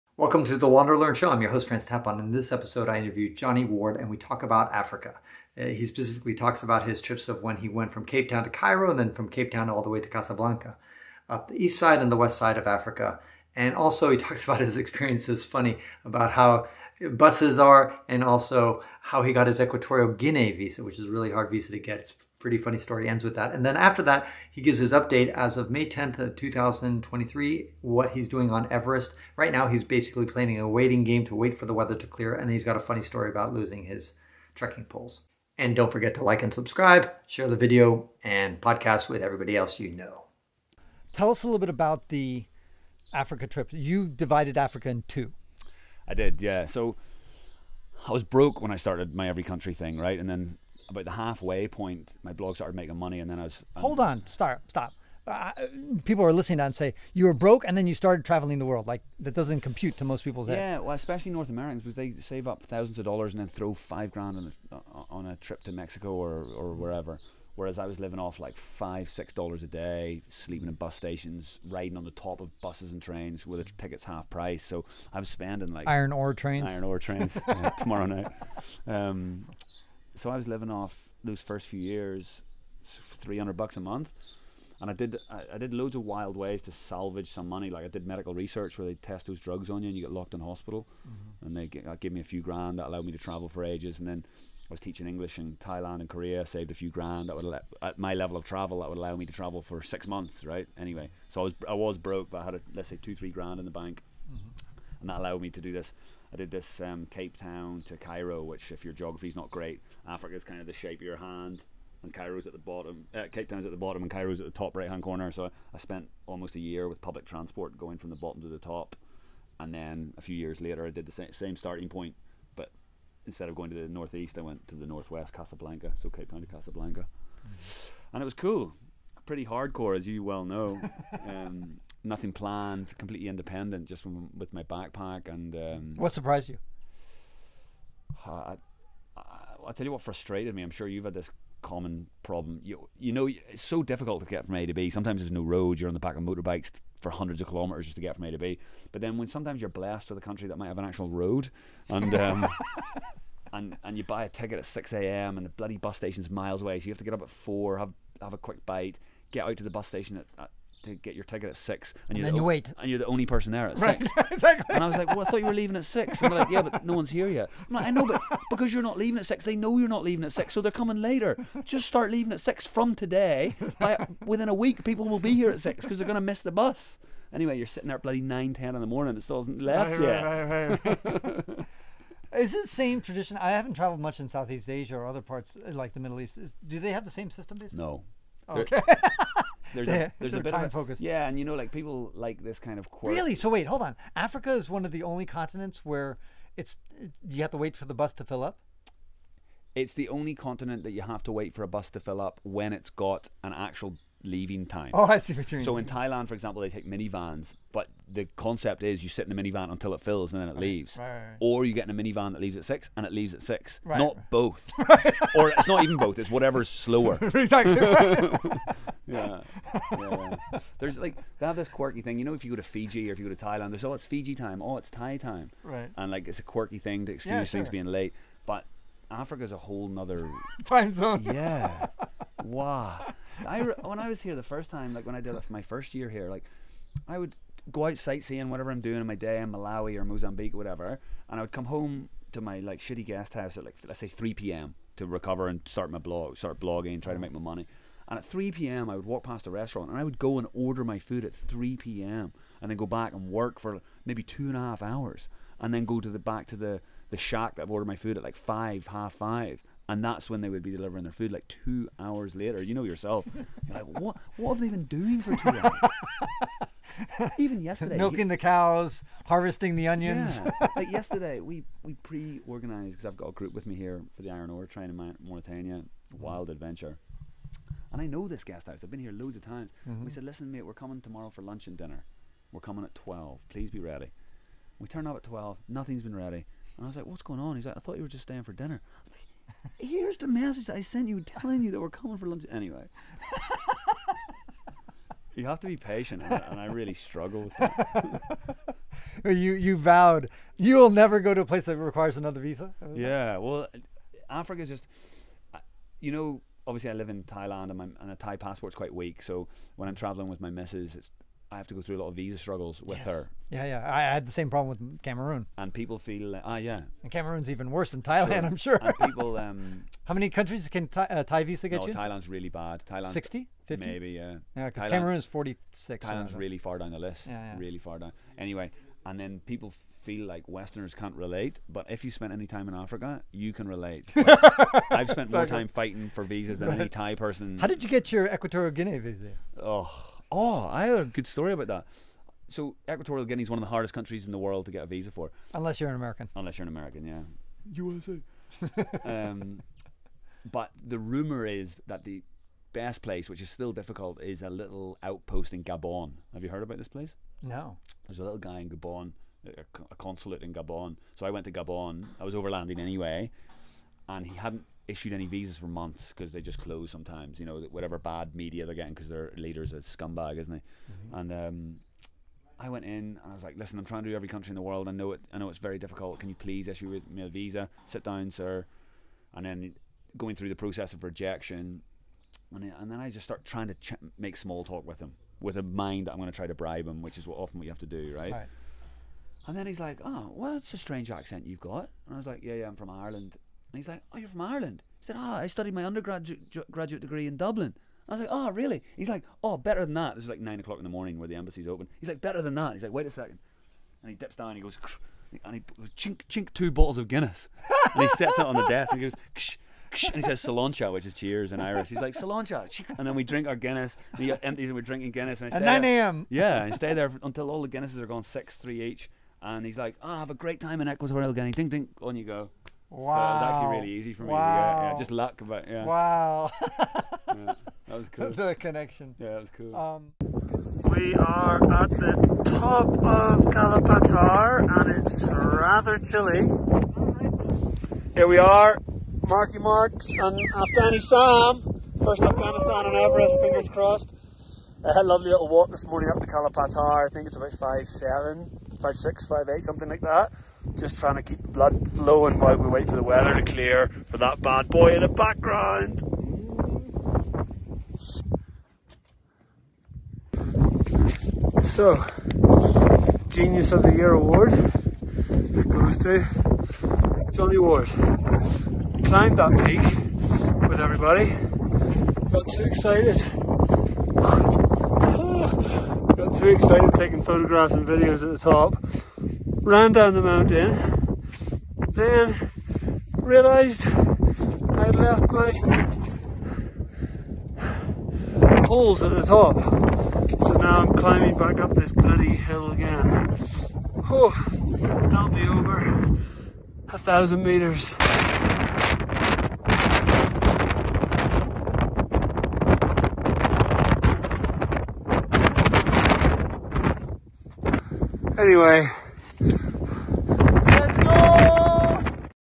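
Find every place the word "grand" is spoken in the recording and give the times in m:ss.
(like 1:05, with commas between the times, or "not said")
1:04, 1:32, 1:36, 1:43.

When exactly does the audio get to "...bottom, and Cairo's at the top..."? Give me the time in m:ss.
1:53.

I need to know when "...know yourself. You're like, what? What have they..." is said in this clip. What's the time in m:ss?
4:22.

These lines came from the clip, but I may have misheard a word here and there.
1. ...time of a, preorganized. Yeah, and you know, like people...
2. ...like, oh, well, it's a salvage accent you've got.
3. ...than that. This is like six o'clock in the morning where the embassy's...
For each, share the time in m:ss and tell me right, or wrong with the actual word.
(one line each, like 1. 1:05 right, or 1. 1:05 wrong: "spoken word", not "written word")
1. 3:10 wrong: "focused", not "preorganized"
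2. 6:29 wrong: "strange", not "salvage"
3. 6:39 wrong: "nine", not "six".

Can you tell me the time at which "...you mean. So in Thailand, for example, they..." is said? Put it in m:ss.
3:25.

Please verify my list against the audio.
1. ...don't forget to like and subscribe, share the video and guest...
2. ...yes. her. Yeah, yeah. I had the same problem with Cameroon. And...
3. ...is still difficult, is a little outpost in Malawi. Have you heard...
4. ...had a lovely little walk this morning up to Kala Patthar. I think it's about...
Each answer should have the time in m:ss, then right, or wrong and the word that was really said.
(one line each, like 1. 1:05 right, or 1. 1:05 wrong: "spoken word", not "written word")
1. 0:35 wrong: "podcast", not "guest"
2. 5:12 right
3. 5:53 wrong: "Gabon", not "Malawi"
4. 7:24 right.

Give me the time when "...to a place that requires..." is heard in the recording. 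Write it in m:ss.
5:01.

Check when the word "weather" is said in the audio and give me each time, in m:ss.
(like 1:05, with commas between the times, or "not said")
0:31, 7:33.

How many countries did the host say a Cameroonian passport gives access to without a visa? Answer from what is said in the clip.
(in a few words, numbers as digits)
46.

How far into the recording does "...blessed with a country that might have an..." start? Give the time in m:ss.
2:29.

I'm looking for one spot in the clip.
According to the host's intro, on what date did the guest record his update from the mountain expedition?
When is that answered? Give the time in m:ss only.
0:25.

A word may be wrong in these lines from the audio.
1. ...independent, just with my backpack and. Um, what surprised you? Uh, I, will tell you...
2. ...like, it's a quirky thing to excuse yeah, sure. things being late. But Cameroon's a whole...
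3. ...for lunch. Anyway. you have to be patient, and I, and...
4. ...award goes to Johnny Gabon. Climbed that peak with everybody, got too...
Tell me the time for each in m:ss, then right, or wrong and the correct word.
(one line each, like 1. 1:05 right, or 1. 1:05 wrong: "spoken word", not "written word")
1. 2:13 right
2. 3:46 wrong: "Africa", not "Cameroon"
3. 4:52 right
4. 7:44 wrong: "Ward", not "Gabon".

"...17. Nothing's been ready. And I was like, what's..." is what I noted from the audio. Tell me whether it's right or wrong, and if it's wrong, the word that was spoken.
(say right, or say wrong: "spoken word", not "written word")
wrong: "12", not "17".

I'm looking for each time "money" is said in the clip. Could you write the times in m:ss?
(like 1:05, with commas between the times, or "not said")
0:52, 1:27, 4:07.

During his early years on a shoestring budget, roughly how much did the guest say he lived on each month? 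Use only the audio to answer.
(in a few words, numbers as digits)
300 dollars.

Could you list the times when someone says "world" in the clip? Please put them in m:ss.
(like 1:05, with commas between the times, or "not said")
0:58, 5:44, 6:14.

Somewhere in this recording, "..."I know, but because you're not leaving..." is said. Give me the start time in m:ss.
2:47.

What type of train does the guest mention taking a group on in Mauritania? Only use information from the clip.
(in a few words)
Iron ore train.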